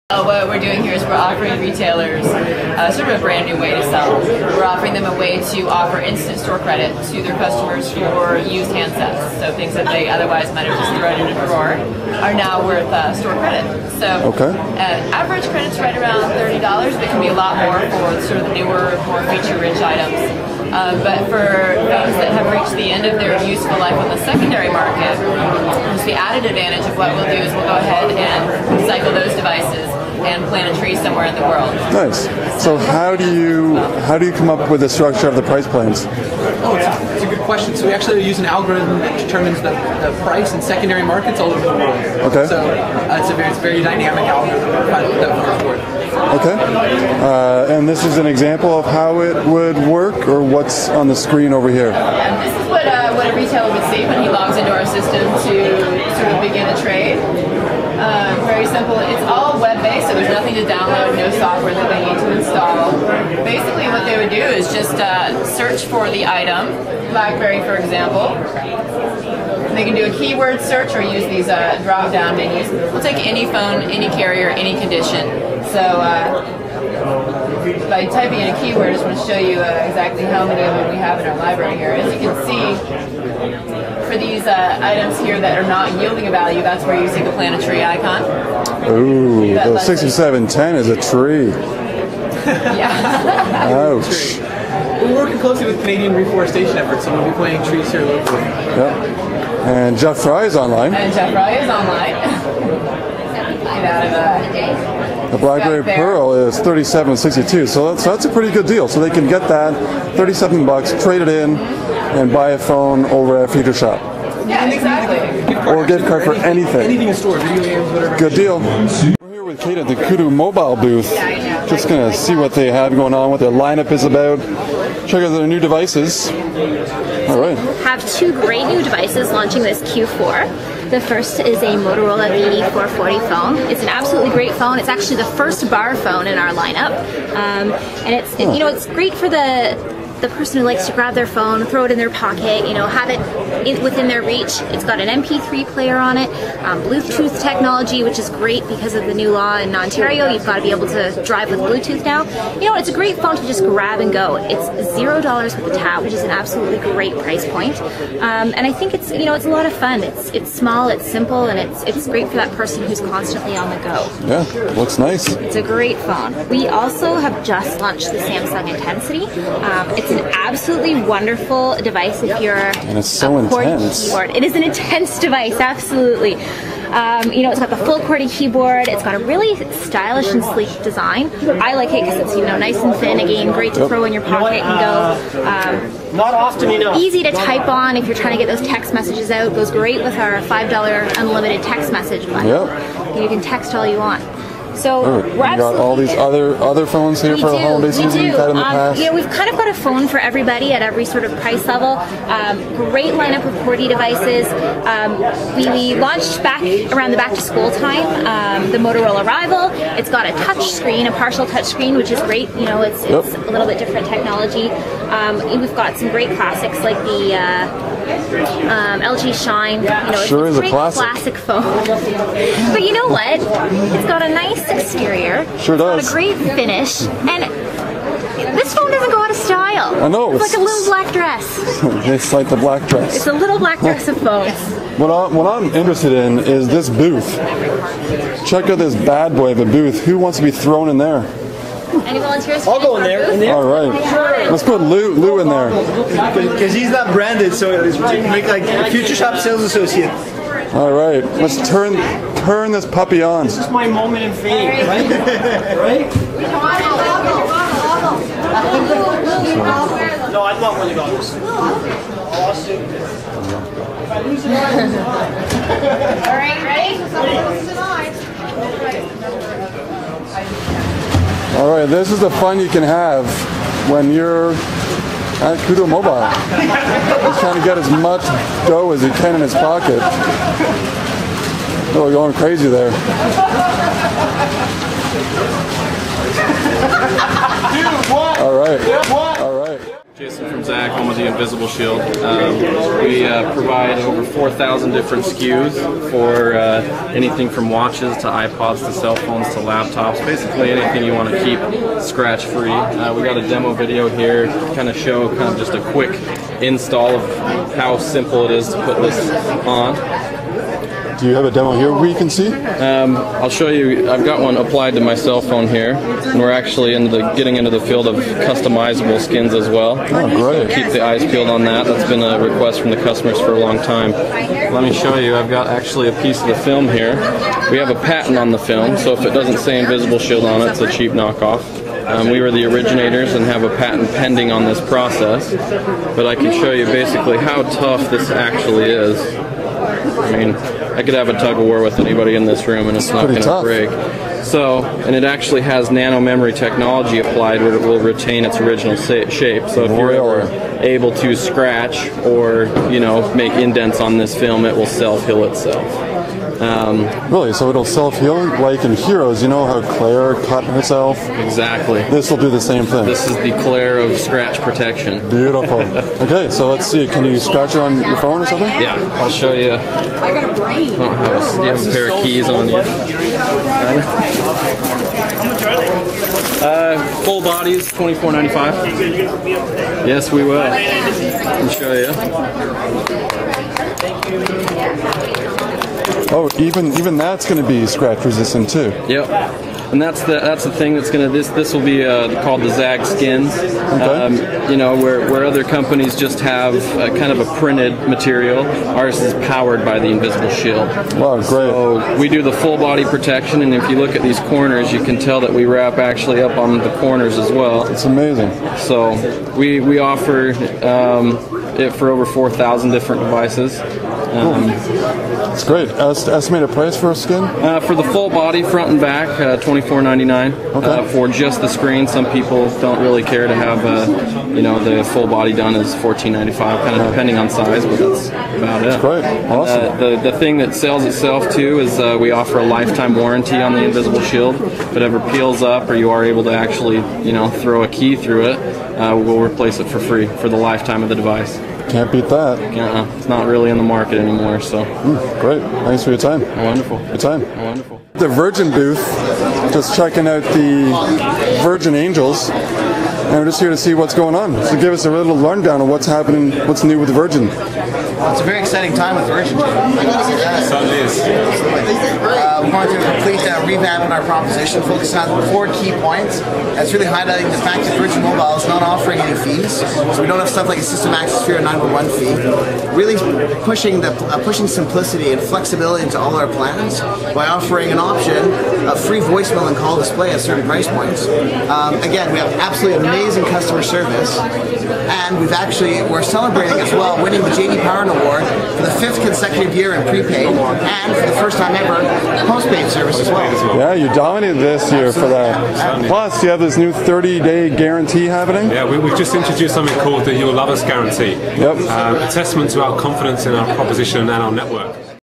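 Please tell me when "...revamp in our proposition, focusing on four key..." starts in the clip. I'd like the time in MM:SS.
07:43.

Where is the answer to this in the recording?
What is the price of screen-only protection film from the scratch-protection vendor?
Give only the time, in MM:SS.
07:05.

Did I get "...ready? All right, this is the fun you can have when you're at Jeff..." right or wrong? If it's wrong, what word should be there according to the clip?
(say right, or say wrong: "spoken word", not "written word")
wrong: "Koodo", not "Jeff".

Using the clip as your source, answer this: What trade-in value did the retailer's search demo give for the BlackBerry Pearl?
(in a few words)
$37.62.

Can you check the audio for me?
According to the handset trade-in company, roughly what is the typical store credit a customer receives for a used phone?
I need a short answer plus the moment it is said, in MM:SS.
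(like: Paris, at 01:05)
$30, at 00:16.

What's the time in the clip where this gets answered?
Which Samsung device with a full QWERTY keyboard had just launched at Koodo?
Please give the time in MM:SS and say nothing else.
02:48.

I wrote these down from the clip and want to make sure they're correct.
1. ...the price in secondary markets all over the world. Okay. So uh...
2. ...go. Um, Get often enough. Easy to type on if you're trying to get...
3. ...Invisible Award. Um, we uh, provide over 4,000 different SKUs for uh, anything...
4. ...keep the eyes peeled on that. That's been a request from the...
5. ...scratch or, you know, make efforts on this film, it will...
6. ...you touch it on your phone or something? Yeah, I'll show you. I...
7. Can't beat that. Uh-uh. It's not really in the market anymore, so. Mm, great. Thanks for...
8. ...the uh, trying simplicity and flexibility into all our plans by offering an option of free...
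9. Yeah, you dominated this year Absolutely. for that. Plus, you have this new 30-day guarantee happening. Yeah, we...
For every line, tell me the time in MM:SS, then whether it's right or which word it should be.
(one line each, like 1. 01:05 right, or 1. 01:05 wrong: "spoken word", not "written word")
1. 00:39 right
2. 03:05 wrong: "Not", not "Get"
3. 04:51 wrong: "Shield", not "Award"
4. 05:20 right
5. 05:51 wrong: "indents", not "efforts"
6. 06:07 wrong: "scratch", not "touch"
7. 07:21 right
8. 07:54 wrong: "pushing", not "trying"
9. 08:13 right.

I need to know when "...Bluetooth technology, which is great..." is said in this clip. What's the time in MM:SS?
02:26.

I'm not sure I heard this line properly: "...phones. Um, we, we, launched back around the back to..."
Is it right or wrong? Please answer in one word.
wrong.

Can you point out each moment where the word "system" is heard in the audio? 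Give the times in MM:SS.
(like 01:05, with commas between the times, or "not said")
00:54, 07:50.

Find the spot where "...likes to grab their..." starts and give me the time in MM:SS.
02:20.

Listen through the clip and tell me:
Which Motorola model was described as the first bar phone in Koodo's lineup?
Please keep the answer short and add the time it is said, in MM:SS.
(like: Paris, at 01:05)
VE440, at 02:12.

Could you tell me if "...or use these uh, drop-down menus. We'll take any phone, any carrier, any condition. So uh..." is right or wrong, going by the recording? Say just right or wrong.
right.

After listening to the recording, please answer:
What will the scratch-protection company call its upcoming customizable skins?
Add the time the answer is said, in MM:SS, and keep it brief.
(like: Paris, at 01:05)
ZAGG skin, at 06:32.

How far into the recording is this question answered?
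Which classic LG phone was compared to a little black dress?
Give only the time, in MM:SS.
03:39.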